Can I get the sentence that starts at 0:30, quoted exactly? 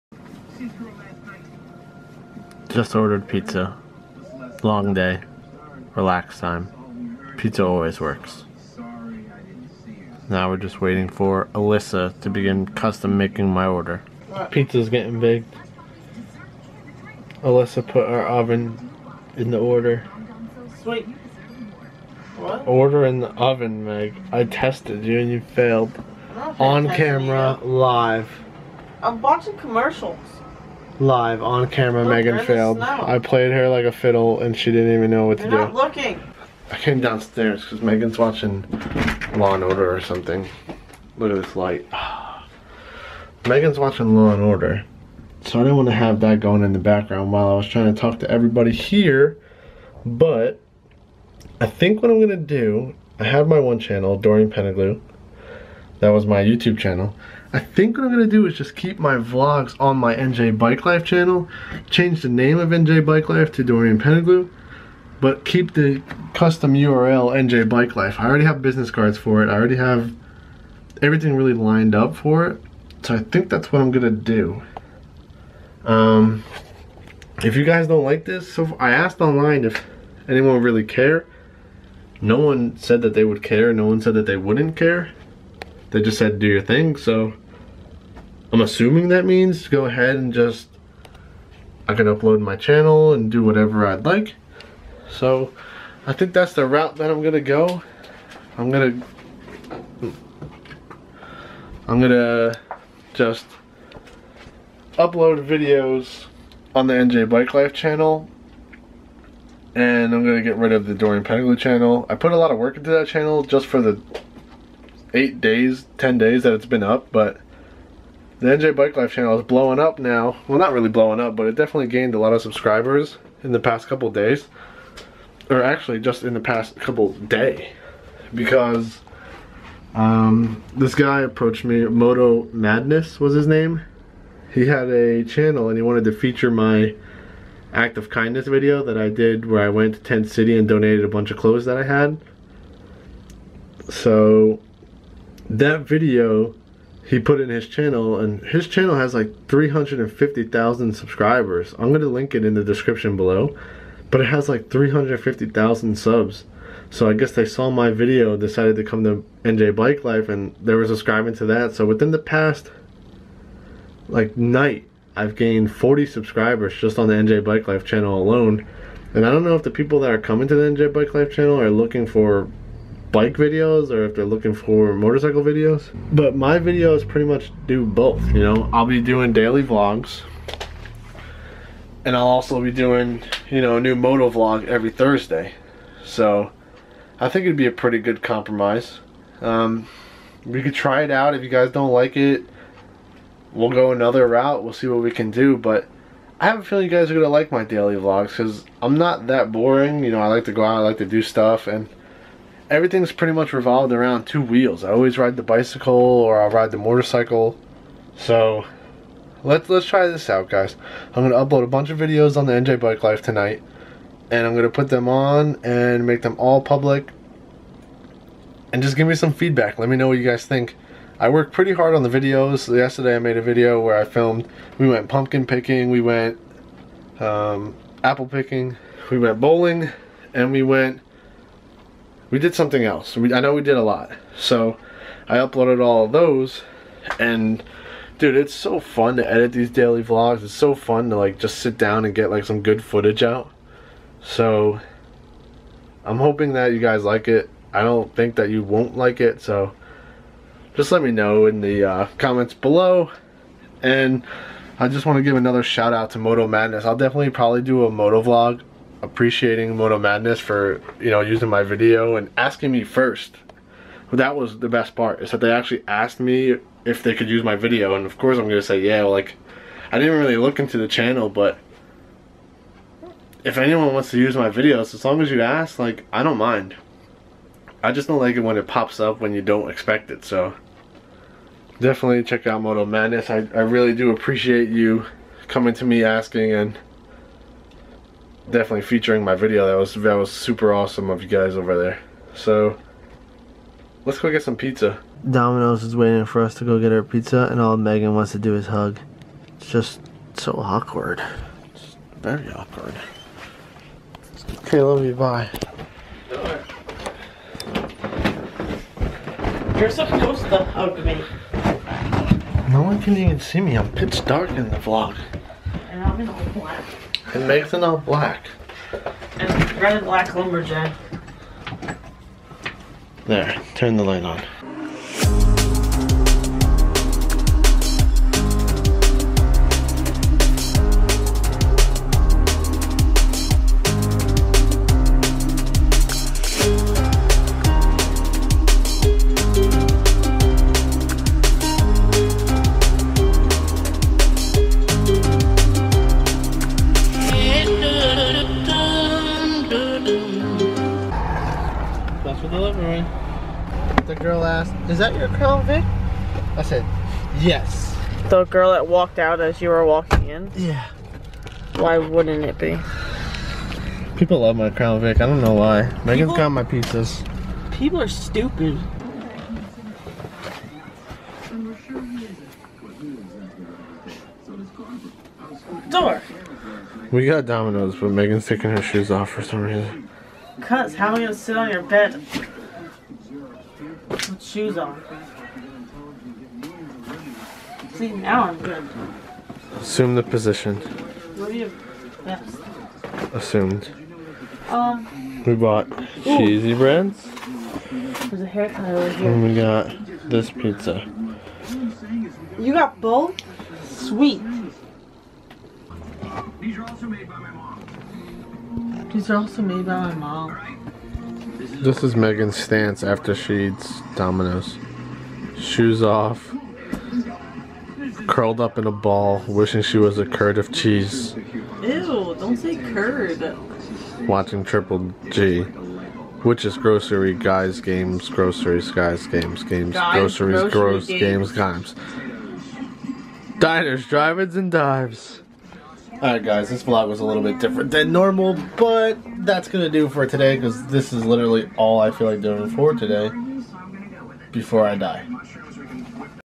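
Live on camera, Look, oh, Megan failed.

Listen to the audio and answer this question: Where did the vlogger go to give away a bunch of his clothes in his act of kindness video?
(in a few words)
Tent City.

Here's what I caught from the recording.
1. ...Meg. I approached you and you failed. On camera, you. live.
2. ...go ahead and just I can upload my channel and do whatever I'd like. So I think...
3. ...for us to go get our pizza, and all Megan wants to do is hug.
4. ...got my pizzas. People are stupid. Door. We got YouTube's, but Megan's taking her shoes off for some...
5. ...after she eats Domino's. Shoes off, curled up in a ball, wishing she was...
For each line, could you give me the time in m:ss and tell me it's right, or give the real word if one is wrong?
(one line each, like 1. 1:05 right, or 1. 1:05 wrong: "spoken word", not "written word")
1. 0:23 wrong: "tested", not "approached"
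2. 1:29 right
3. 4:56 right
4. 6:06 wrong: "Domino", not "YouTube"
5. 6:53 right.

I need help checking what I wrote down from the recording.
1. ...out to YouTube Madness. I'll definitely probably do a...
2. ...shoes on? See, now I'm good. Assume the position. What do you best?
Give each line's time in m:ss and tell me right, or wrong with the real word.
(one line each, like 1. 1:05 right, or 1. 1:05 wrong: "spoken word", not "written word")
1. 4:15 wrong: "Moto", not "YouTube"
2. 6:24 right.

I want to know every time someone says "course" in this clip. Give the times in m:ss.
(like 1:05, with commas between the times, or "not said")
4:28.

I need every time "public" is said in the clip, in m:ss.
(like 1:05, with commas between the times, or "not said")
3:36.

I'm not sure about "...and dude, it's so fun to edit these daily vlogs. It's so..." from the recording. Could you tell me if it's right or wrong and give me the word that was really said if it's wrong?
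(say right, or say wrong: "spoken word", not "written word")
right.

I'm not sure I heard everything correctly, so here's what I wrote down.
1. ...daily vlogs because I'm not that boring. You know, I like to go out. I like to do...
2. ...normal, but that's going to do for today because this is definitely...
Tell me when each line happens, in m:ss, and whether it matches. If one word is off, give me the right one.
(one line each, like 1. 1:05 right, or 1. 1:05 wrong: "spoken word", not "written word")
1. 3:17 right
2. 7:18 wrong: "literally", not "definitely".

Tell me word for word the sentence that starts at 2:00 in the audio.
Well, not really blowing up, but it definitely gained a lot of subscribers in the past couple days.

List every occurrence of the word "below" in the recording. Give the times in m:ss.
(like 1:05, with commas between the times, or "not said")
2:33, 4:12.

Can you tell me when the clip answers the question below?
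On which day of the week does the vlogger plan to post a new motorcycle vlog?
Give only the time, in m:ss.
3:04.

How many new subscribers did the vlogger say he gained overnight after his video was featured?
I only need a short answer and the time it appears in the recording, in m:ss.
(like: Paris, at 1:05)
40, at 2:45.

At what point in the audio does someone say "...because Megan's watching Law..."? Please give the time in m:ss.
0:37.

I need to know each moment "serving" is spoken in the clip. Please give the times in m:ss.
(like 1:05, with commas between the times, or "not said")
not said.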